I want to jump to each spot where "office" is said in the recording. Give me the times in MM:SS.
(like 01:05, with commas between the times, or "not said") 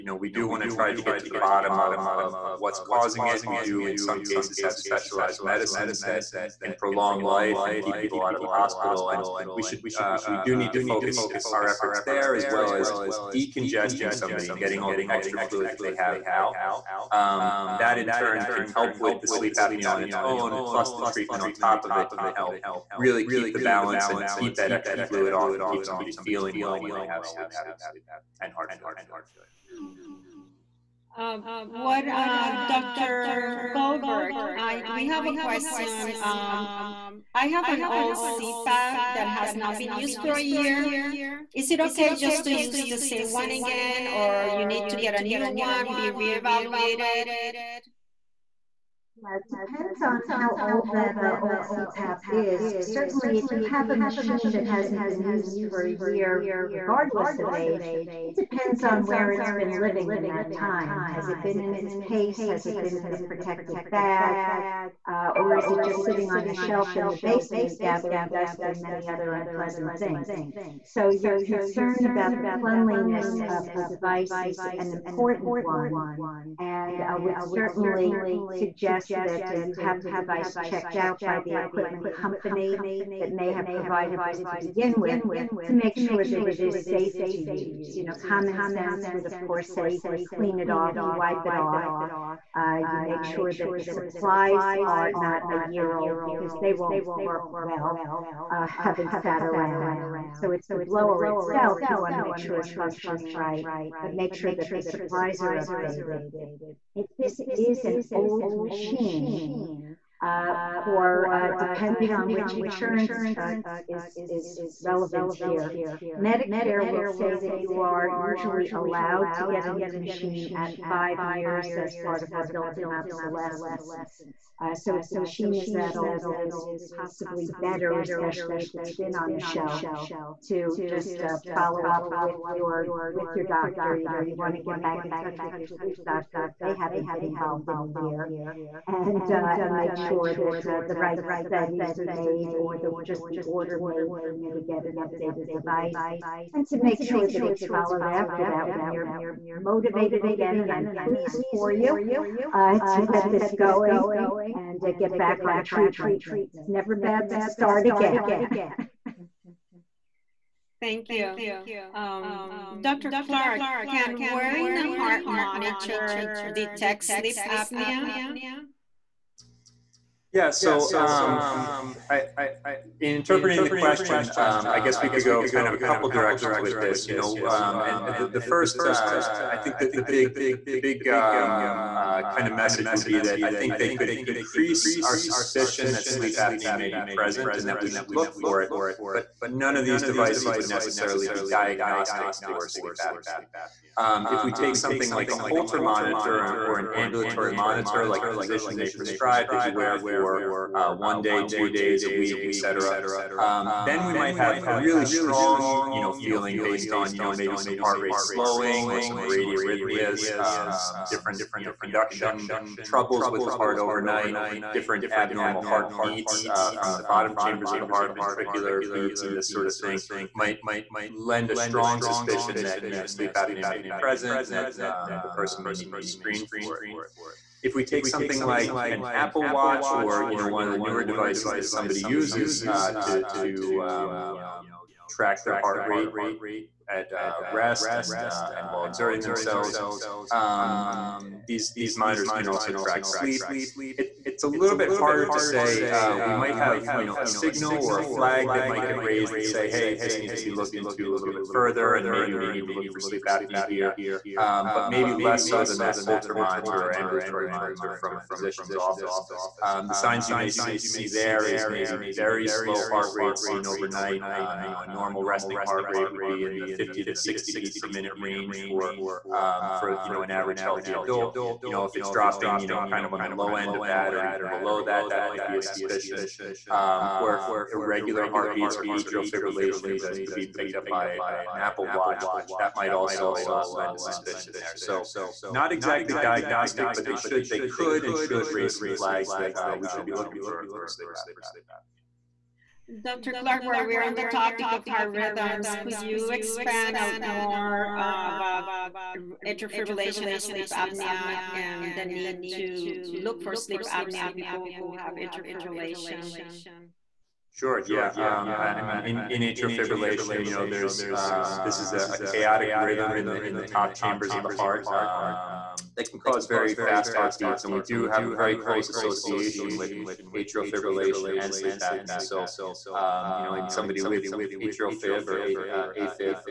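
04:18.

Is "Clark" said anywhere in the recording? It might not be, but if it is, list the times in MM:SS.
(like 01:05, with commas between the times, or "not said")
02:43, 04:53.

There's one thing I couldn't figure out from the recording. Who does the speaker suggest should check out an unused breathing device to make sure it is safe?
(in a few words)
the equipment company.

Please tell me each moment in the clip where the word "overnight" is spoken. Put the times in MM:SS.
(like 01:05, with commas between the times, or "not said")
03:33, 04:23.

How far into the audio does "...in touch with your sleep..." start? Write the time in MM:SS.
02:15.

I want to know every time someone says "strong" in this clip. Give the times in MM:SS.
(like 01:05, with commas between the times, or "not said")
03:25, 03:41.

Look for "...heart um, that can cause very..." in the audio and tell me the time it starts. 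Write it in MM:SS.
05:14.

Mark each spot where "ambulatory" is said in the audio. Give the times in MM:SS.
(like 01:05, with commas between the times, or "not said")
03:16, 04:16.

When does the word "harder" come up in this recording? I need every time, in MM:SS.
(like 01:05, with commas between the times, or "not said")
04:04.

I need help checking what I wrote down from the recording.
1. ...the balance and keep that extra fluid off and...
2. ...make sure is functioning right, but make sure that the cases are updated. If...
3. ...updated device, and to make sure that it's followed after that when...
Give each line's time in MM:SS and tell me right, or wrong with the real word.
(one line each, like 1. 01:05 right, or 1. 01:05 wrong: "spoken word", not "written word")
1. 00:23 right
2. 01:42 wrong: "supplies", not "cases"
3. 02:24 right.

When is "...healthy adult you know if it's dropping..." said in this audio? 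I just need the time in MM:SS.
04:30.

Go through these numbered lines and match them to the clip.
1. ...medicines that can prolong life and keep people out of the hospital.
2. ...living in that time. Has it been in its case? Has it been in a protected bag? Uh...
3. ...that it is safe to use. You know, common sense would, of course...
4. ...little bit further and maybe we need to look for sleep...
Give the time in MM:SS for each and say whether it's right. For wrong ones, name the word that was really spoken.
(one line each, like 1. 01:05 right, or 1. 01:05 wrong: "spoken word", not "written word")
1. 00:05 right
2. 00:59 right
3. 01:26 right
4. 04:11 right.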